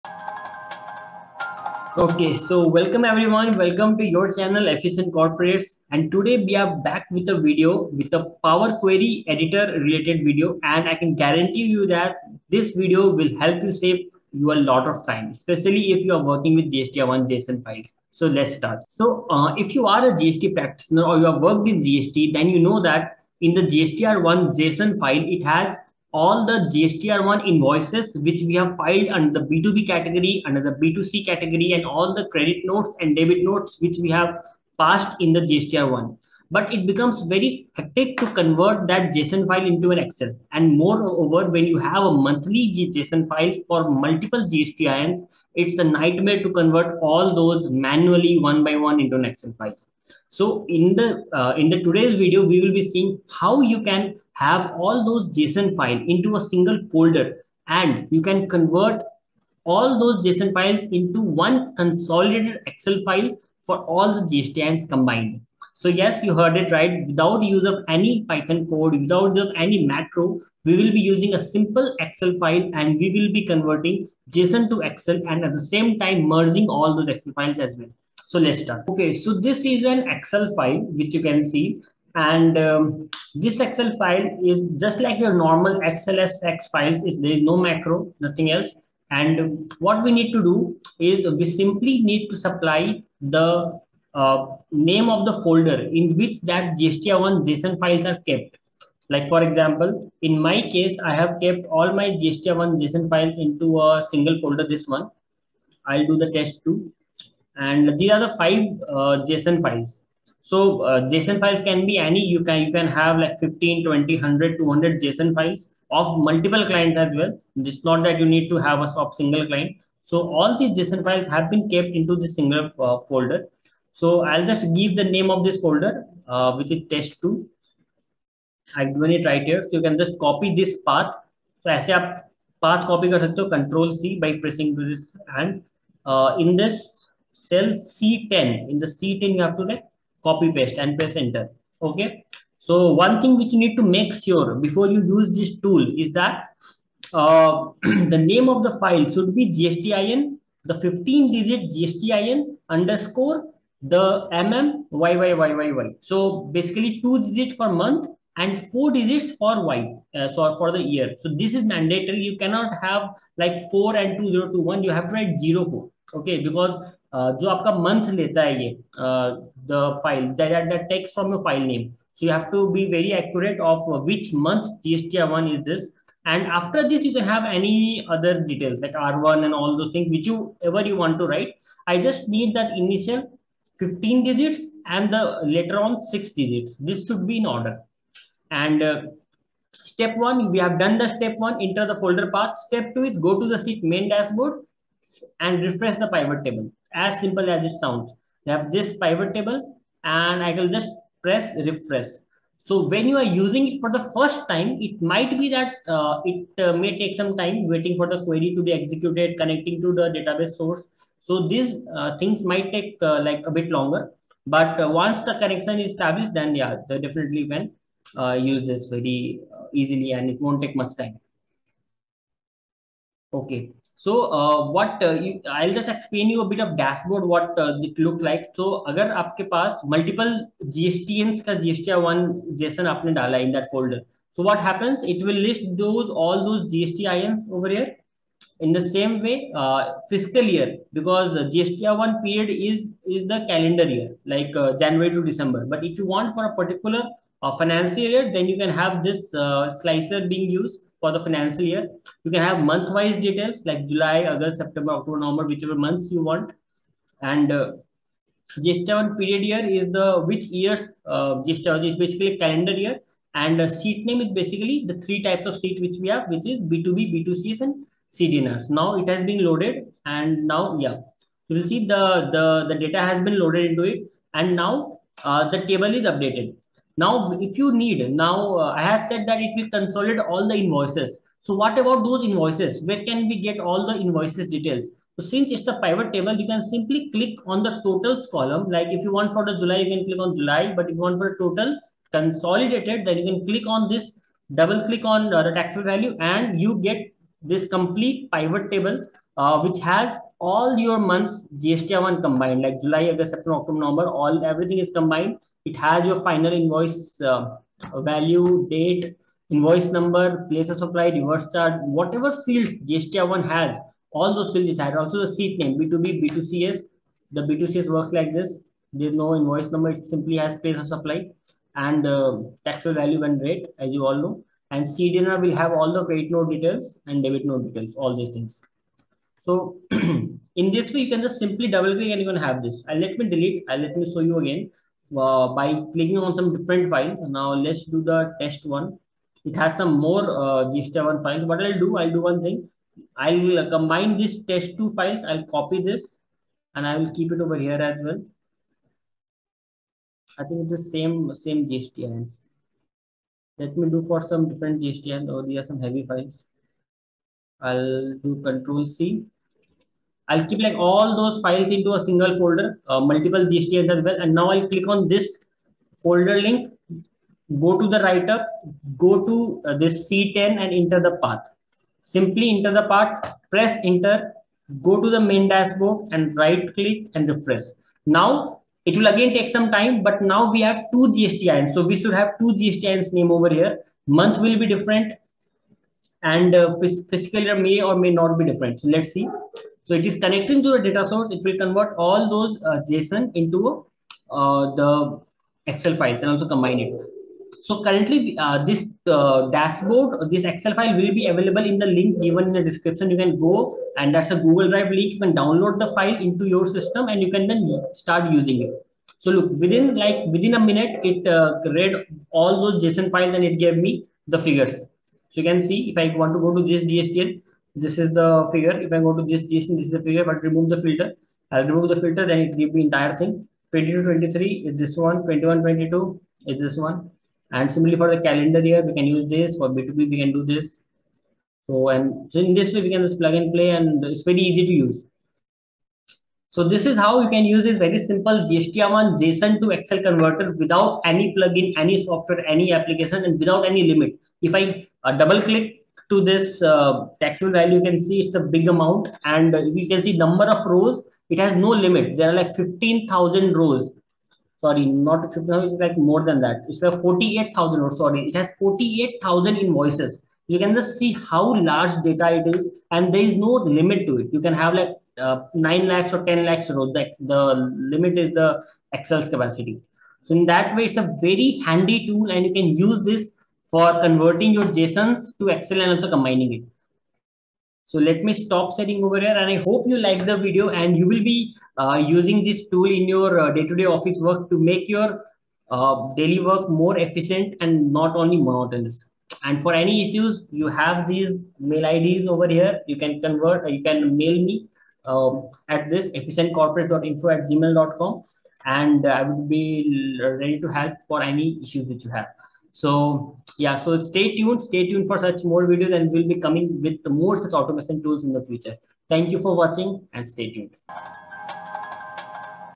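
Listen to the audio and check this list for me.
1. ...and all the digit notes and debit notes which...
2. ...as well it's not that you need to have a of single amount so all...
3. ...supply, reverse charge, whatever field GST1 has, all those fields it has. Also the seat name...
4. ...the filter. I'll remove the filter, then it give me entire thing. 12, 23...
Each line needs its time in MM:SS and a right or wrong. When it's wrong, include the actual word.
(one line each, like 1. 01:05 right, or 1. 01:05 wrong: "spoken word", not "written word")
1. 00:31 wrong: "credit", not "digit"
2. 01:56 wrong: "client", not "amount"
3. 05:10 right
4. 07:00 wrong: "22", not "12".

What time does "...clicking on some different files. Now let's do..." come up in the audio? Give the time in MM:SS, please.
05:35.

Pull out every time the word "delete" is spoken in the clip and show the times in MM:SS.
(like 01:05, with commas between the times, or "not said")
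05:33.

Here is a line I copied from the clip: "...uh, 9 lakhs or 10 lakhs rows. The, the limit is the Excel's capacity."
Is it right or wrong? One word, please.
right.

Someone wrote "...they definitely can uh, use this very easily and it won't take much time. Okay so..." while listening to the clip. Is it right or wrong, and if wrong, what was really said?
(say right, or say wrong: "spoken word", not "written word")
right.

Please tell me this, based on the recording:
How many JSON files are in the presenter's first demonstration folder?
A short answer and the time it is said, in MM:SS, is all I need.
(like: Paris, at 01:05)
5, at 01:48.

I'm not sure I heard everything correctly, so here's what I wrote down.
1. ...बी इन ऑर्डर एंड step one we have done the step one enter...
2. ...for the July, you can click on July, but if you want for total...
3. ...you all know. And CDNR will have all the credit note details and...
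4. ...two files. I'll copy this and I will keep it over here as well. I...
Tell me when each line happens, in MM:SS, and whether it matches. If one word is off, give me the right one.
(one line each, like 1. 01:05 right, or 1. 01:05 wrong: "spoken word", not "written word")
1. 03:07 right
2. 04:49 right
3. 05:23 right
4. 05:44 right.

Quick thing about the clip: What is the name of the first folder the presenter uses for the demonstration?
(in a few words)
test2.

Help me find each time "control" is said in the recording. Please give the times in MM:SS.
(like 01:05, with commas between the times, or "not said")
02:13, 05:58.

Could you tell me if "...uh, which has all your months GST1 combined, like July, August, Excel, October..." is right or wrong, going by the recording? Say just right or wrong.
wrong.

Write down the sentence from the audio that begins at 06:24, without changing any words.
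Month will be different, and uh, fiscal year may or may not be different.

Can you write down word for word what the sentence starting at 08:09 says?
And for any issues, you have these mail IDs over here.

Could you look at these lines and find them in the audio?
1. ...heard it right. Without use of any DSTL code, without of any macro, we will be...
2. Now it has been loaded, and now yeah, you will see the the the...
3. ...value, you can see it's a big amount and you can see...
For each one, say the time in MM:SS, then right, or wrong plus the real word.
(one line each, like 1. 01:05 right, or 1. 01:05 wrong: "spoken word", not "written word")
1. 01:06 wrong: "Python", not "DSTL"
2. 04:28 right
3. 07:27 right.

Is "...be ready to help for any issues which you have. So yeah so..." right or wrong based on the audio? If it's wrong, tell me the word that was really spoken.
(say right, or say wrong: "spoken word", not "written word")
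right.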